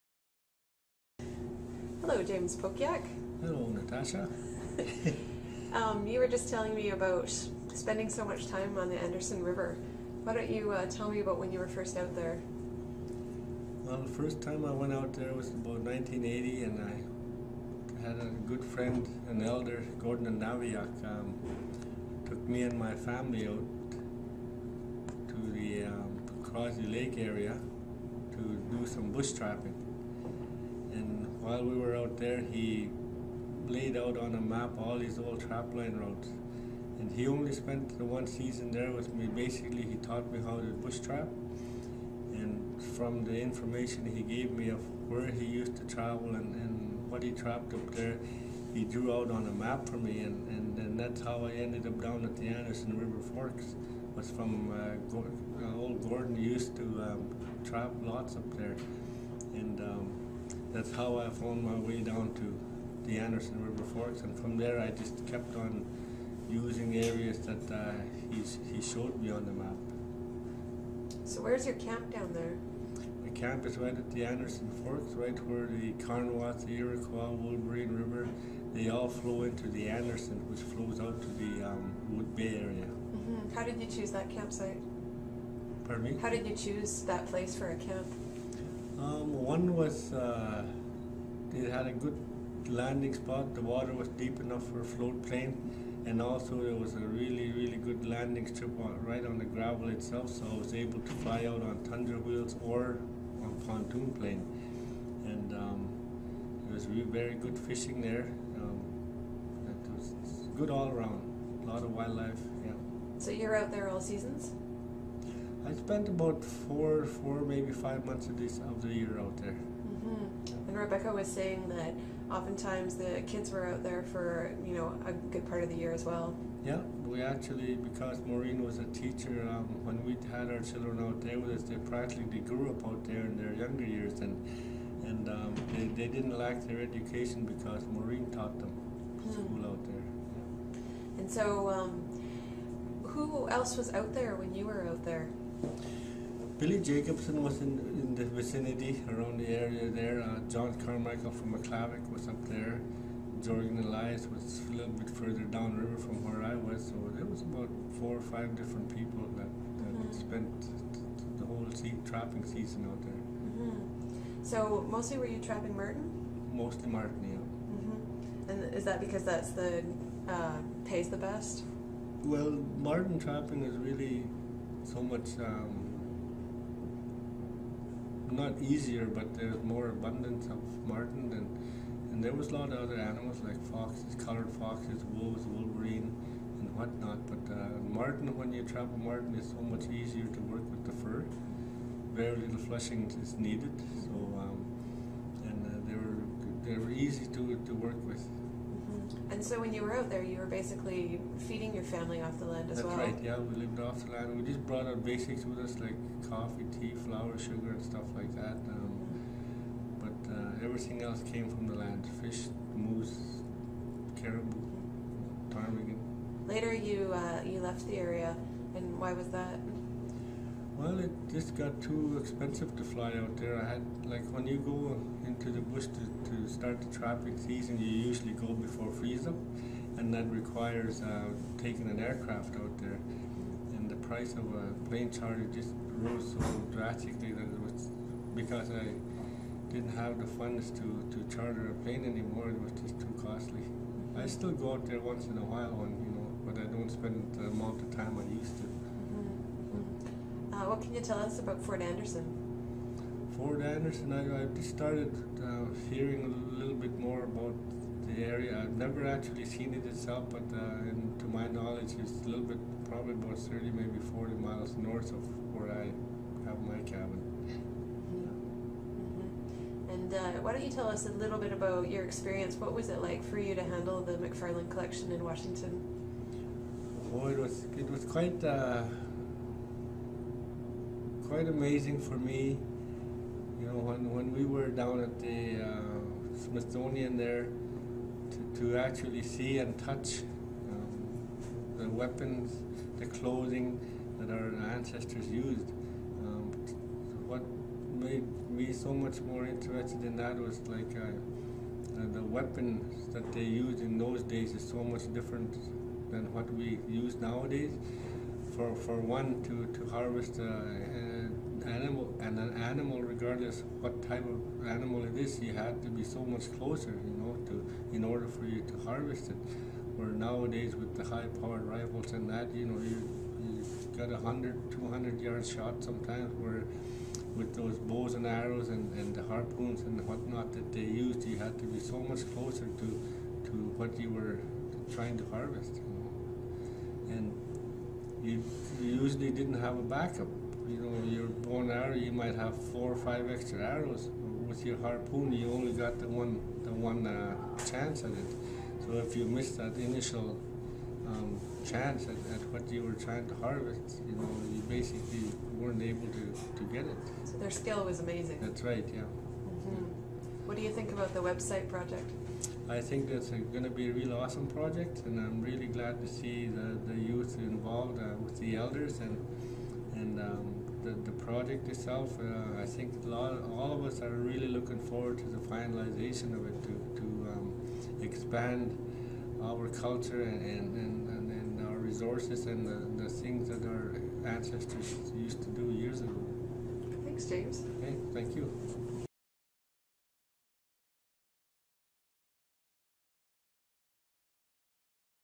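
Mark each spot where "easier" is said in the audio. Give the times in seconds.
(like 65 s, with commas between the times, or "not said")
178 s, 189 s.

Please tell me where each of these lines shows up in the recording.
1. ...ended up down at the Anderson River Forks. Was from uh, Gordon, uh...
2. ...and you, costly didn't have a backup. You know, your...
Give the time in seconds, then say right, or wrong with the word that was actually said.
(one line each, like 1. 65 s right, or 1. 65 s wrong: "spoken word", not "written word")
1. 51 s right
2. 337 s wrong: "usually", not "costly".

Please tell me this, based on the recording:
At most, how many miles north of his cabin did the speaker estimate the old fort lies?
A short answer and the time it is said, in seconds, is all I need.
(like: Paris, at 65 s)
40, at 264 s.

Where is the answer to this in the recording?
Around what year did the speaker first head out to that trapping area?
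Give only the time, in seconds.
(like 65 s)
15 s.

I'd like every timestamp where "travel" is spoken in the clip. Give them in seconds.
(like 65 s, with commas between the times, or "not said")
45 s, 188 s.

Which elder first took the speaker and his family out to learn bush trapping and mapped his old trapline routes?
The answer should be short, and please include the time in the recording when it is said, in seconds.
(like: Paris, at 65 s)
Gordon Naviak, at 19 s.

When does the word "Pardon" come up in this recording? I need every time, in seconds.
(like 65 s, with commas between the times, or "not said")
85 s.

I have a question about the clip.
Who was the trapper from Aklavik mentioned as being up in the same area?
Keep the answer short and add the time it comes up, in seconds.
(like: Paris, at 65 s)
John Carmichael, at 150 s.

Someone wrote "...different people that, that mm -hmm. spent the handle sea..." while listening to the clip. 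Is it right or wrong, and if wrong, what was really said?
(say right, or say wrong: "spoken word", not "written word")
wrong: "whole", not "handle".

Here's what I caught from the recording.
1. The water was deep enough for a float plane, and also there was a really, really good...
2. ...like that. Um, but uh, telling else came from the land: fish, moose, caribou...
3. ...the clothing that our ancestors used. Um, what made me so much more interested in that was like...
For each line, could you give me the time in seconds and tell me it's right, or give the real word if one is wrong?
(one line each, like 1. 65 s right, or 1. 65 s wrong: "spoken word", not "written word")
1. 93 s right
2. 208 s wrong: "everything", not "telling"
3. 292 s right.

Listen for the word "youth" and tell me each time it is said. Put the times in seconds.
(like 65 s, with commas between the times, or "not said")
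366 s.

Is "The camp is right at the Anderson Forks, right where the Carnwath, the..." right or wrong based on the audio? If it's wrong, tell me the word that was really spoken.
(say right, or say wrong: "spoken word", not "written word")
right.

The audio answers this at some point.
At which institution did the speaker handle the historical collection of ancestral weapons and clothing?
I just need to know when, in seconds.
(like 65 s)
286 s.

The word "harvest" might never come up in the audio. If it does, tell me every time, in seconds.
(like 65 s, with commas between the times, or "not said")
309 s, 318 s, 335 s, 353 s.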